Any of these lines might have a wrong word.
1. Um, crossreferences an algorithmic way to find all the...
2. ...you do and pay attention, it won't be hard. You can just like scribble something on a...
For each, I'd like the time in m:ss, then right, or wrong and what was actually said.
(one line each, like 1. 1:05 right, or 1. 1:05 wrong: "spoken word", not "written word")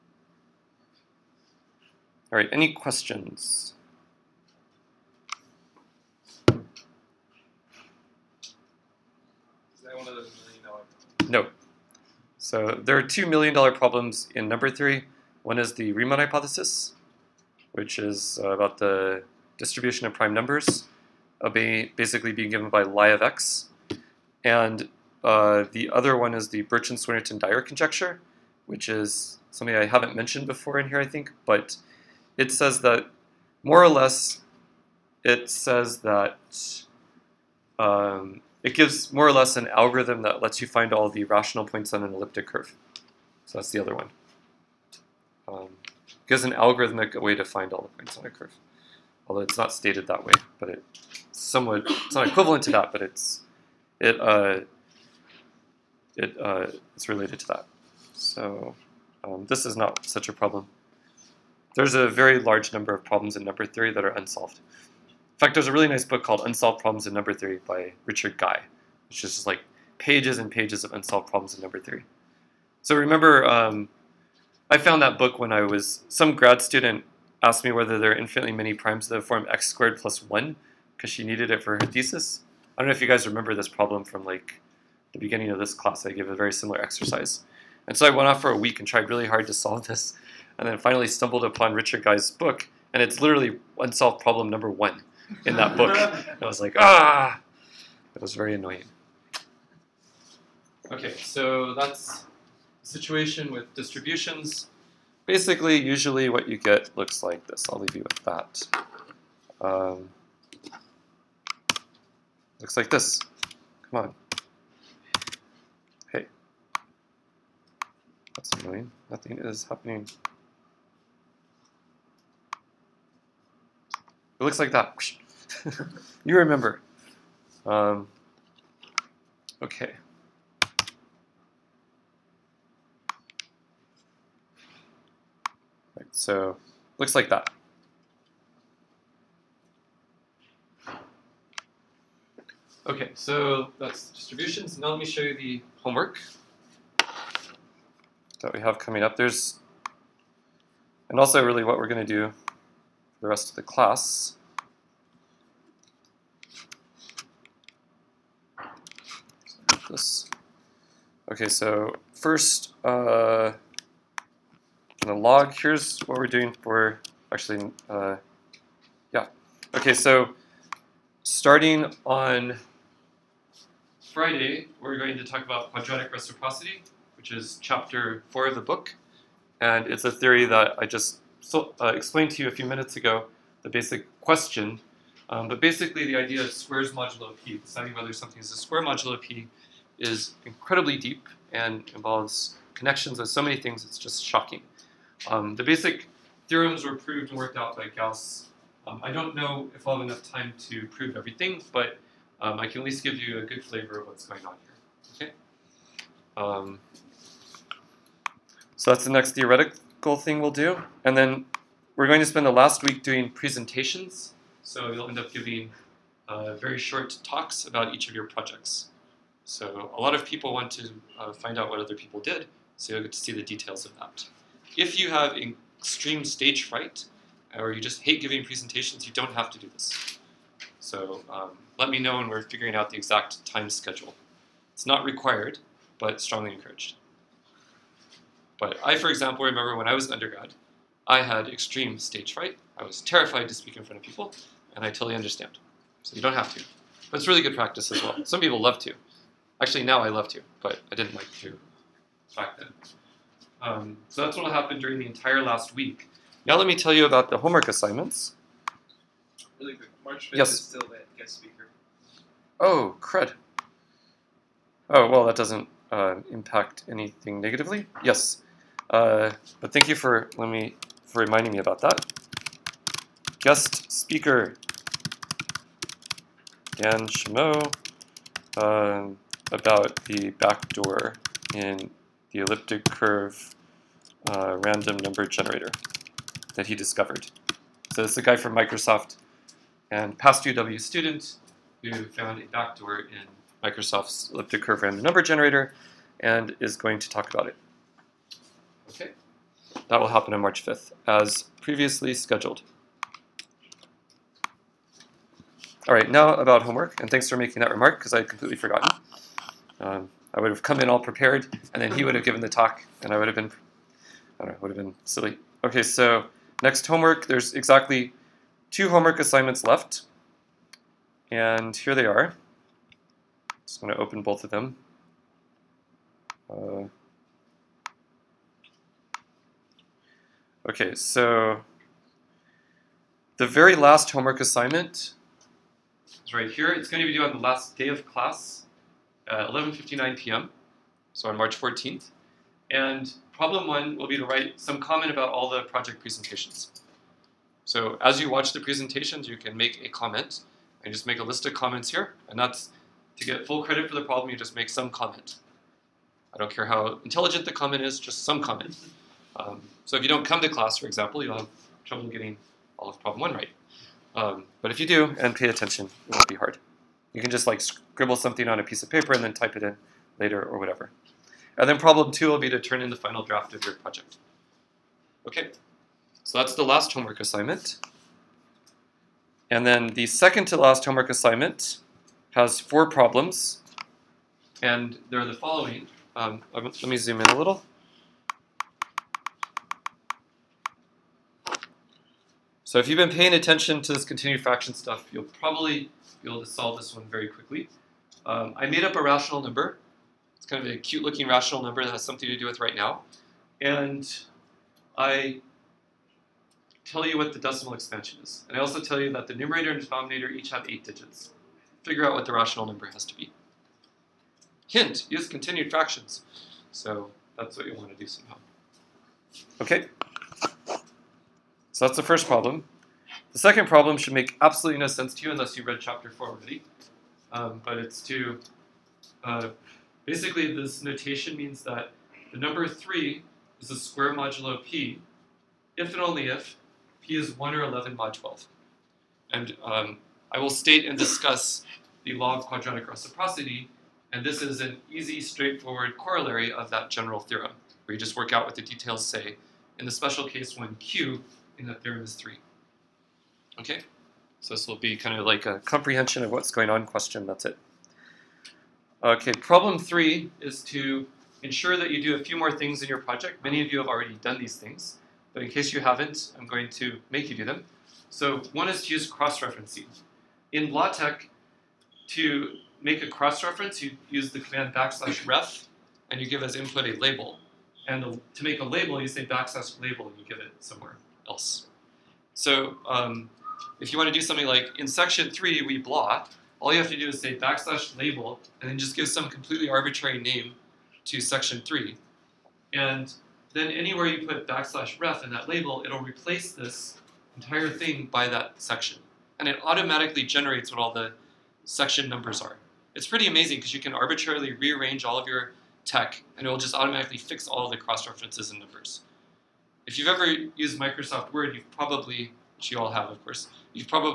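1. 0:45 wrong: "gives", not "crossreferences"
2. 6:04 right.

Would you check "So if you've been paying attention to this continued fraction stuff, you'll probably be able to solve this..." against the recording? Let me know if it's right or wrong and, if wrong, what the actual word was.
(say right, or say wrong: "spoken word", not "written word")
right.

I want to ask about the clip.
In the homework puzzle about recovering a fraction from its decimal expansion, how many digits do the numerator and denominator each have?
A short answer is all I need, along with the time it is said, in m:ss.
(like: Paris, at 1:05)
8, at 6:50.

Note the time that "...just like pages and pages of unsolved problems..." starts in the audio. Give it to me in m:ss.
1:09.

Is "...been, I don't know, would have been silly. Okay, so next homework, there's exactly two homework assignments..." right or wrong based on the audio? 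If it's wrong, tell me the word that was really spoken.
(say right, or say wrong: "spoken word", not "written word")
right.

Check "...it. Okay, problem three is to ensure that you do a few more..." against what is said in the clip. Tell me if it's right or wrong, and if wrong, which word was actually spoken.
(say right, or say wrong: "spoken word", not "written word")
right.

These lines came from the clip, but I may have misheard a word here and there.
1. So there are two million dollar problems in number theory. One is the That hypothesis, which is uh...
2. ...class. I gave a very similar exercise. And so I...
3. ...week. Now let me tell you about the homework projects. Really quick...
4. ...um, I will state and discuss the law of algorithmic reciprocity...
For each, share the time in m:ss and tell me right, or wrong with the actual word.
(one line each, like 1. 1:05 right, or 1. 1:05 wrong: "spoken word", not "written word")
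1. 0:12 wrong: "Riemann", not "That"
2. 1:25 right
3. 4:15 wrong: "assignments", not "projects"
4. 7:19 wrong: "quadratic", not "algorithmic".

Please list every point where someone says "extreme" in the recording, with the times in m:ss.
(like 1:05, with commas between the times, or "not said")
3:45, 4:01.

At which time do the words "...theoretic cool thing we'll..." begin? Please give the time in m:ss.
3:29.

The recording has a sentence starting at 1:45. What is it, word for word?
Basically, usually what you get looks like this.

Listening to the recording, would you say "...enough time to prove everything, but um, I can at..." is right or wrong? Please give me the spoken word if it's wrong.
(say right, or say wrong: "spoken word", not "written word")
right.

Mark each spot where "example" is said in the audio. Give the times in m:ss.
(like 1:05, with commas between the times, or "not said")
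3:59, 6:00.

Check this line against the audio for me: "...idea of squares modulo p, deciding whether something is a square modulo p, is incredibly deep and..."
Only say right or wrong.
right.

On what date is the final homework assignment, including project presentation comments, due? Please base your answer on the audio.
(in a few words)
March 14.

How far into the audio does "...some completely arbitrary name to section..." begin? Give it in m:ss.
8:09.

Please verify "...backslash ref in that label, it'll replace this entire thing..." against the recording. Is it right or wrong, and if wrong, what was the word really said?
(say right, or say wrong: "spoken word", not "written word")
right.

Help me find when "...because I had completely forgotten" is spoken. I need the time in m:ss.
5:07.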